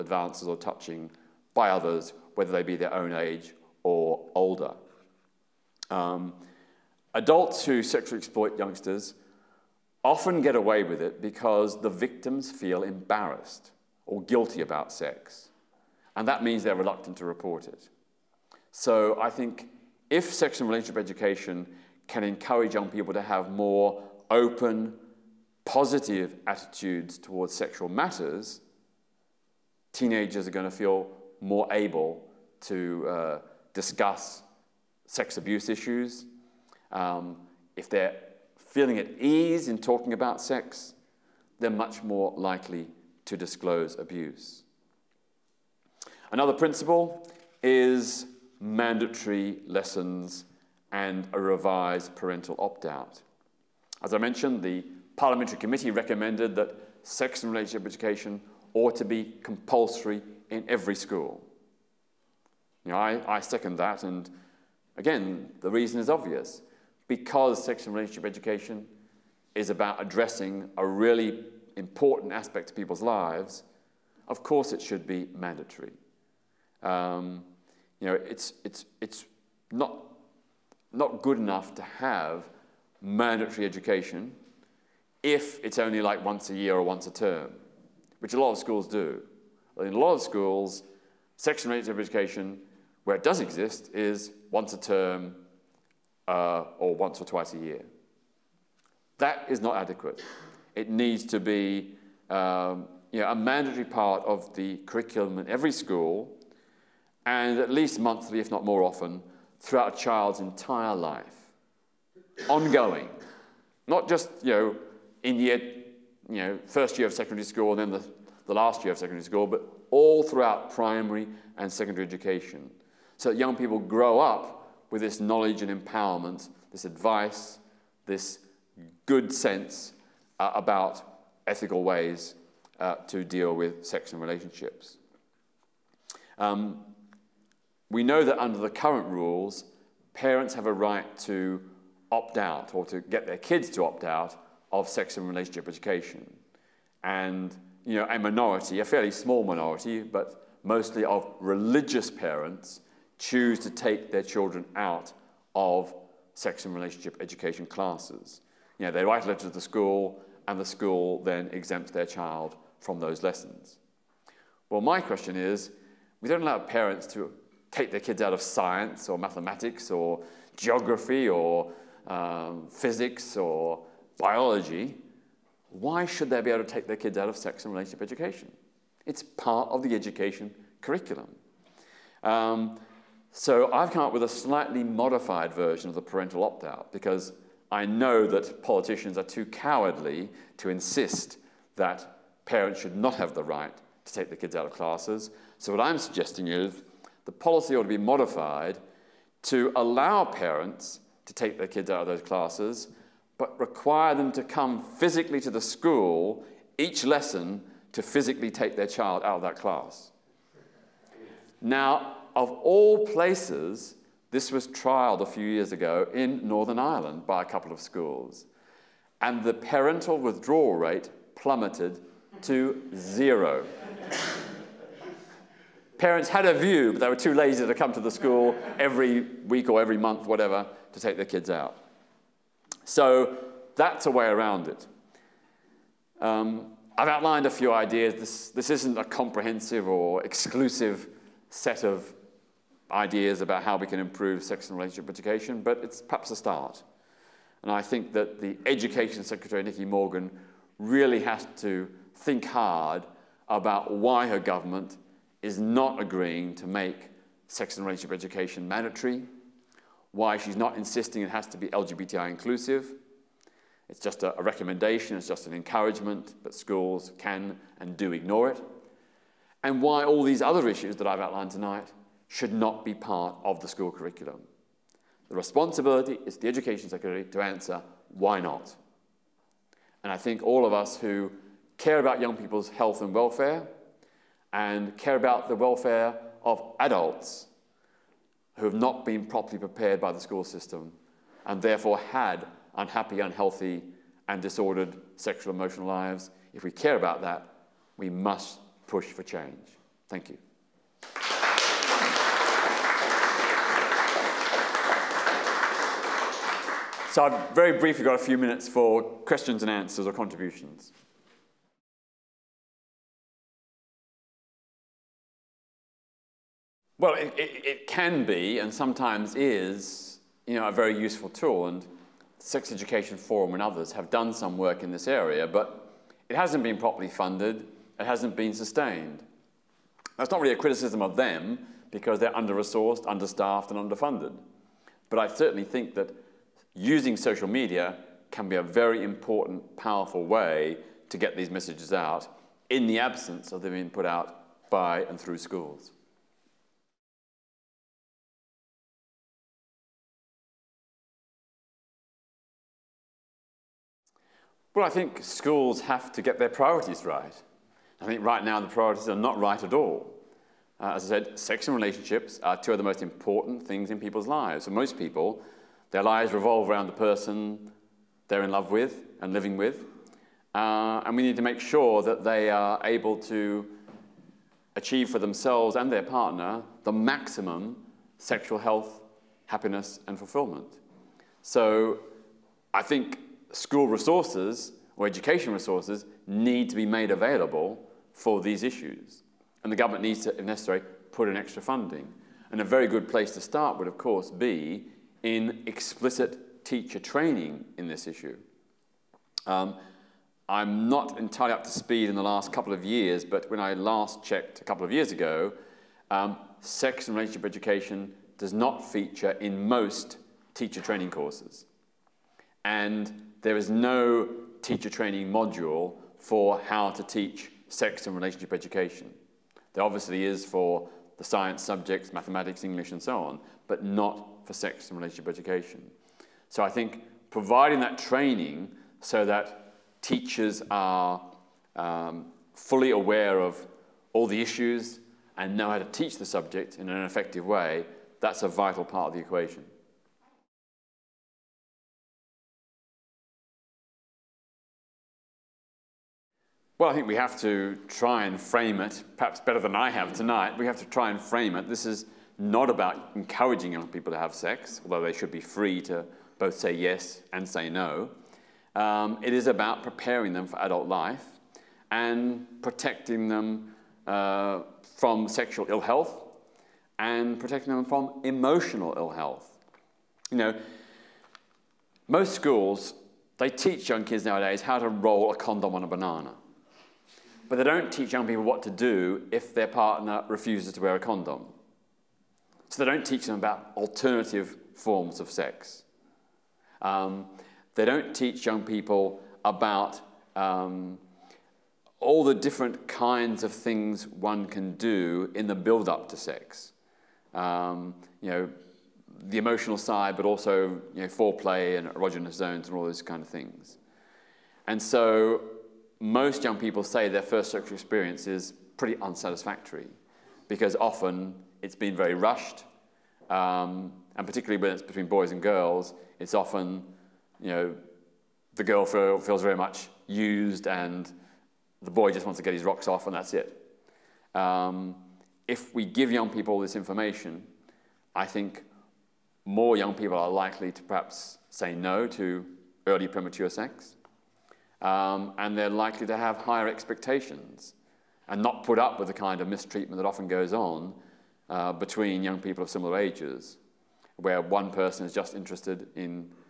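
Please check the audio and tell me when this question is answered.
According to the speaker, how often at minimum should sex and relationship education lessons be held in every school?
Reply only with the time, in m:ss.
1:47.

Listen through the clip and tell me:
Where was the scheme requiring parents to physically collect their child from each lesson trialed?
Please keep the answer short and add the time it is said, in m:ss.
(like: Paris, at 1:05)
Northern Ireland, at 3:36.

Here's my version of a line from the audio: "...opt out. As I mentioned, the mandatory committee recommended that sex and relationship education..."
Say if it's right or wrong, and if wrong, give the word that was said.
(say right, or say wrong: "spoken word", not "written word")
wrong: "parliamentary", not "mandatory".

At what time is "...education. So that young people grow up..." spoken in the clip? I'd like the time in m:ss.
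2:02.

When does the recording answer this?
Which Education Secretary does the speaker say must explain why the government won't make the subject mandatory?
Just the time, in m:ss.
4:09.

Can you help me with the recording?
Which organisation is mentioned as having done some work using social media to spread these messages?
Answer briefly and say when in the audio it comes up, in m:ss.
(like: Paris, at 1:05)
Sex Education Forum, at 5:22.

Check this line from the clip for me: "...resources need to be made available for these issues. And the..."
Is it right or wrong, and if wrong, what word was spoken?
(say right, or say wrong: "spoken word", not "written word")
right.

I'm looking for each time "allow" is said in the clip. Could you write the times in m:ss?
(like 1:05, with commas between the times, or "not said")
2:46, 3:19.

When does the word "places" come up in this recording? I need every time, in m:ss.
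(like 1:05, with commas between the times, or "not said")
3:33, 6:33.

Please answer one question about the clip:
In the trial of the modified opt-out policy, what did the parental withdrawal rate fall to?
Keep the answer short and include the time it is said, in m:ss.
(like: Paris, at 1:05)
0, at 3:42.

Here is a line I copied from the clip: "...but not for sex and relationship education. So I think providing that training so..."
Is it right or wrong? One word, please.
right.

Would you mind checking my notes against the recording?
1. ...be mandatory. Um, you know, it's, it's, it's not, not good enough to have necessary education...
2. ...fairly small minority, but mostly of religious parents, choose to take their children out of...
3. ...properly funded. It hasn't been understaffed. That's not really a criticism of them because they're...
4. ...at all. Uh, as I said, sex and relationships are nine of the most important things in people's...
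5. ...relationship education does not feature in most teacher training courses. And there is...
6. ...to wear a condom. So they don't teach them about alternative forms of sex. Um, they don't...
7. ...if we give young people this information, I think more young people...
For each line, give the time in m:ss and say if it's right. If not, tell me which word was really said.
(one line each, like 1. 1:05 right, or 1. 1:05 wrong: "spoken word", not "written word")
1. 1:15 wrong: "mandatory", not "necessary"
2. 2:28 right
3. 5:26 wrong: "sustained", not "understaffed"
4. 5:59 wrong: "two", not "nine"
5. 6:47 right
6. 8:00 right
7. 8:45 right.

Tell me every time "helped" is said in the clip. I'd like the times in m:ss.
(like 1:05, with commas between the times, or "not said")
not said.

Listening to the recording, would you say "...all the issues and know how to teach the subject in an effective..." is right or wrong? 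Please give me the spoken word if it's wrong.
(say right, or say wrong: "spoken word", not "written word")
right.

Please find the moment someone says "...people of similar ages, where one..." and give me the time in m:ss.
9:02.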